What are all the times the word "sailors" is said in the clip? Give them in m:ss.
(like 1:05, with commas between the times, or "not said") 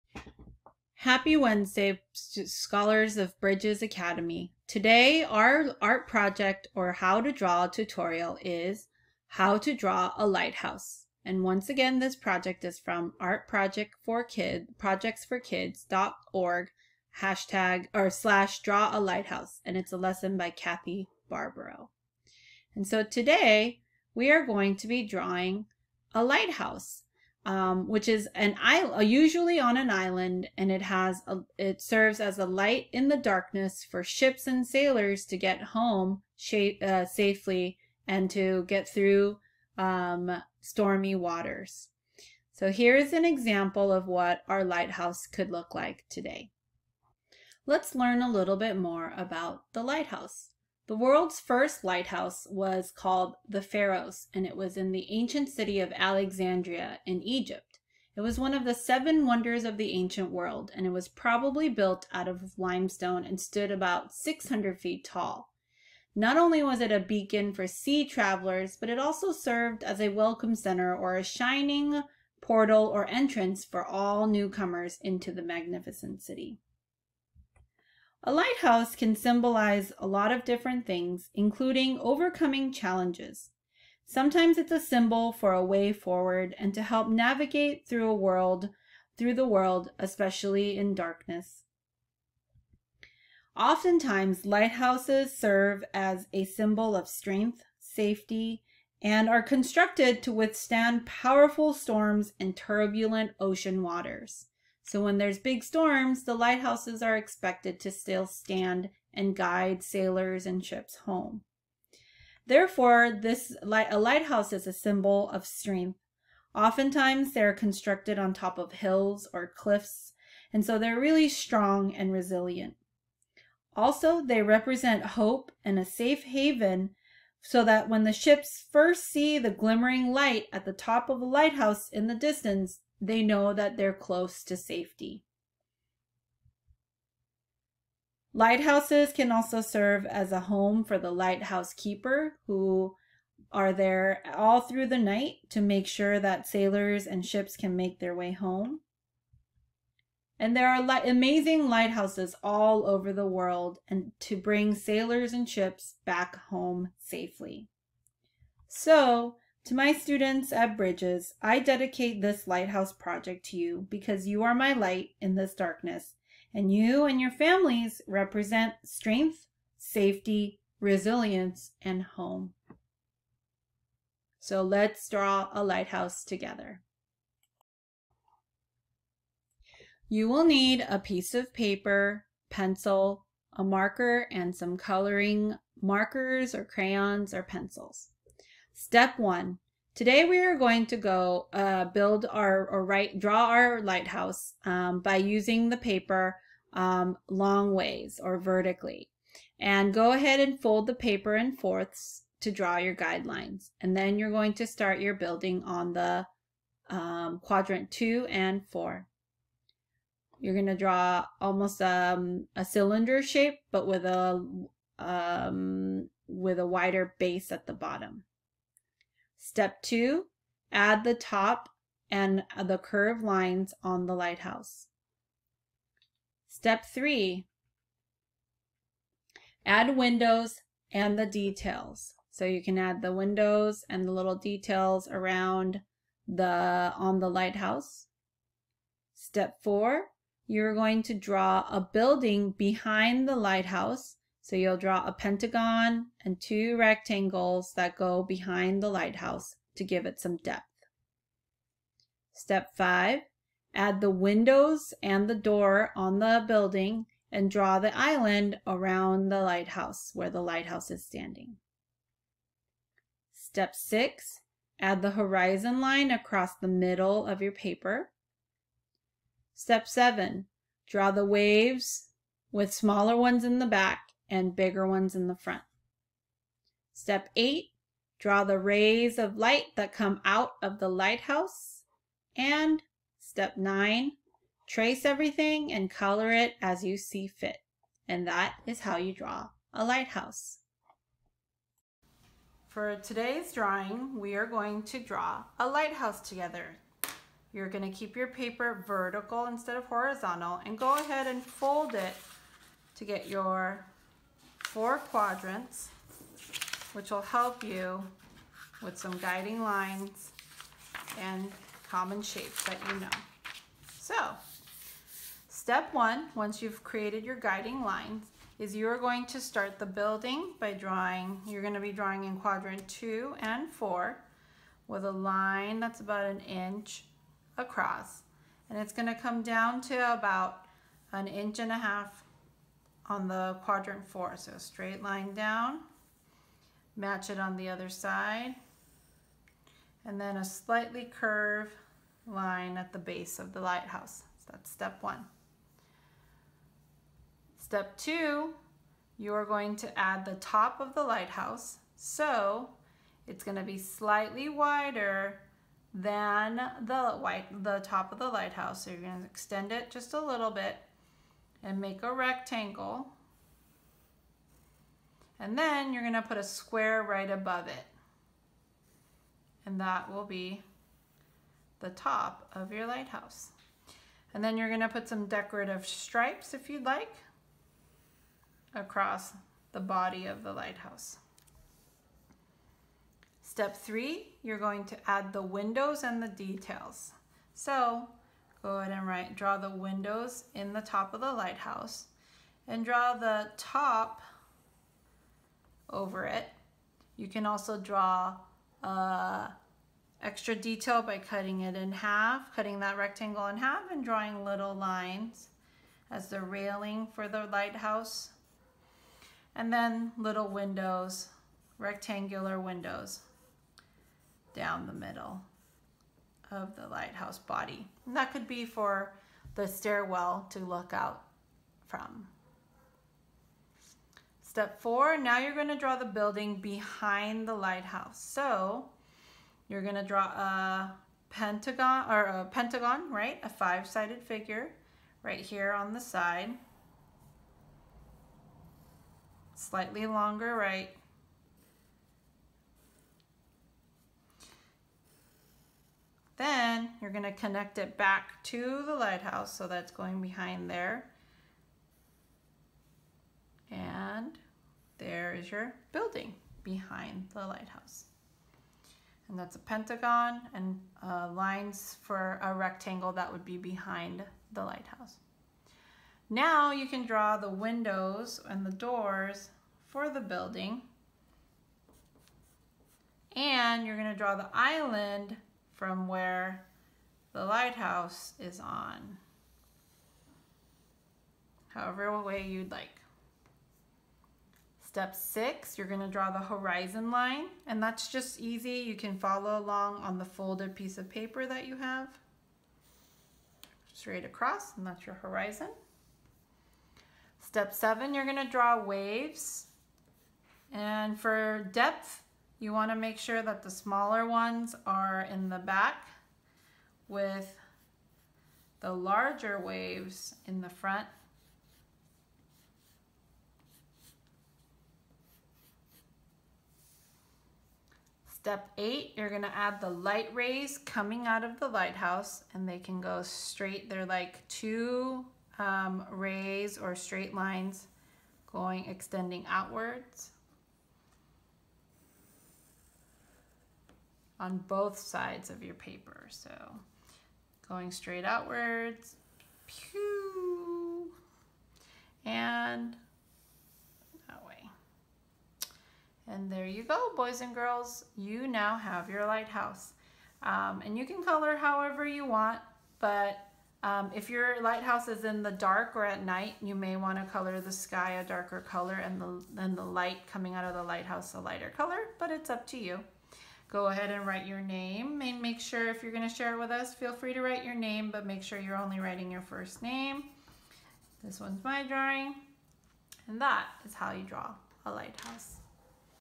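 0:34, 1:49, 2:26, 2:34.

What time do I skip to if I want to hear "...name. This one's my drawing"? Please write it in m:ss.
9:29.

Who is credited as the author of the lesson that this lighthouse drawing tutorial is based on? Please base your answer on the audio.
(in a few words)
Kathy Barbro.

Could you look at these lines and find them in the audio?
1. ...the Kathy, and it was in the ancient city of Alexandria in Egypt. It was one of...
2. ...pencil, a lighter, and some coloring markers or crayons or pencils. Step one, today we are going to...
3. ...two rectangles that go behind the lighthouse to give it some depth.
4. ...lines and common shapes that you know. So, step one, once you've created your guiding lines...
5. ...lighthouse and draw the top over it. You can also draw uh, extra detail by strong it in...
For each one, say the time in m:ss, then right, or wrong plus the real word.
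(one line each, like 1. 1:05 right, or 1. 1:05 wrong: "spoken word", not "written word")
1. 0:53 wrong: "Pharos", not "Kathy"
2. 3:02 wrong: "marker", not "lighter"
3. 4:06 right
4. 5:09 right
5. 6:31 wrong: "cutting", not "strong".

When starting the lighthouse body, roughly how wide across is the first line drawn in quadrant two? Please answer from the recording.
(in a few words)
1 inch.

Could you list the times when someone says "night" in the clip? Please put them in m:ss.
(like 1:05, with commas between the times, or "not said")
2:24, 9:16.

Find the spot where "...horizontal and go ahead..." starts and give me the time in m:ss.
4:59.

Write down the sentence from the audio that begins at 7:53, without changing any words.
And you're gonna draw the island from where the lighthouse is on.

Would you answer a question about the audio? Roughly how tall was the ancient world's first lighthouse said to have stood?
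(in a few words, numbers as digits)
600 feet.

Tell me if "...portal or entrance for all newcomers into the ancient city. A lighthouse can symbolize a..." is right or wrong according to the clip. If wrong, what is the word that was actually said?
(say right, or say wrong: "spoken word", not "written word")
wrong: "magnificent", not "ancient".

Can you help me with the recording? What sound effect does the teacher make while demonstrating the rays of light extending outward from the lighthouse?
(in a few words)
pew.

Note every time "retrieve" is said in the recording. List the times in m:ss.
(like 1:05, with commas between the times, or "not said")
not said.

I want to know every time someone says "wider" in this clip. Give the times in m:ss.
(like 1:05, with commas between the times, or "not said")
3:36, 5:54.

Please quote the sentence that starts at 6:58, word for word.
And that could be for the stairwell to look out from.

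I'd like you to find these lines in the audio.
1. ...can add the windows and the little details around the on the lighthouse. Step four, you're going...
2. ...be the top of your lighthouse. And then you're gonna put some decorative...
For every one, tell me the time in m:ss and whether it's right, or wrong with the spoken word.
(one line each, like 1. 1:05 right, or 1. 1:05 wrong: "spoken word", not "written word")
1. 3:52 right
2. 6:10 right.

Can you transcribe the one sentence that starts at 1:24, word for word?
Sometimes it's a symbol for a way forward and to help navigate through a world, through the world, especially in darkness.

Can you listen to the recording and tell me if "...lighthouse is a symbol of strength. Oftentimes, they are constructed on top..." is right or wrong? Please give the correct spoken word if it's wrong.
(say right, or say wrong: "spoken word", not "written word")
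right.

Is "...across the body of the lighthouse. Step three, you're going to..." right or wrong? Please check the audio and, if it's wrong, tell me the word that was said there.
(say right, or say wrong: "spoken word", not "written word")
right.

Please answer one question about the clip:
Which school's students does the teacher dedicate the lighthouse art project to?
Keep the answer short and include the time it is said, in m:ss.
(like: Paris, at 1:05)
Bridges Academy, at 0:03.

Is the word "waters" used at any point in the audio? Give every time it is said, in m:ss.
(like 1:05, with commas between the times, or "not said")
0:41, 1:43.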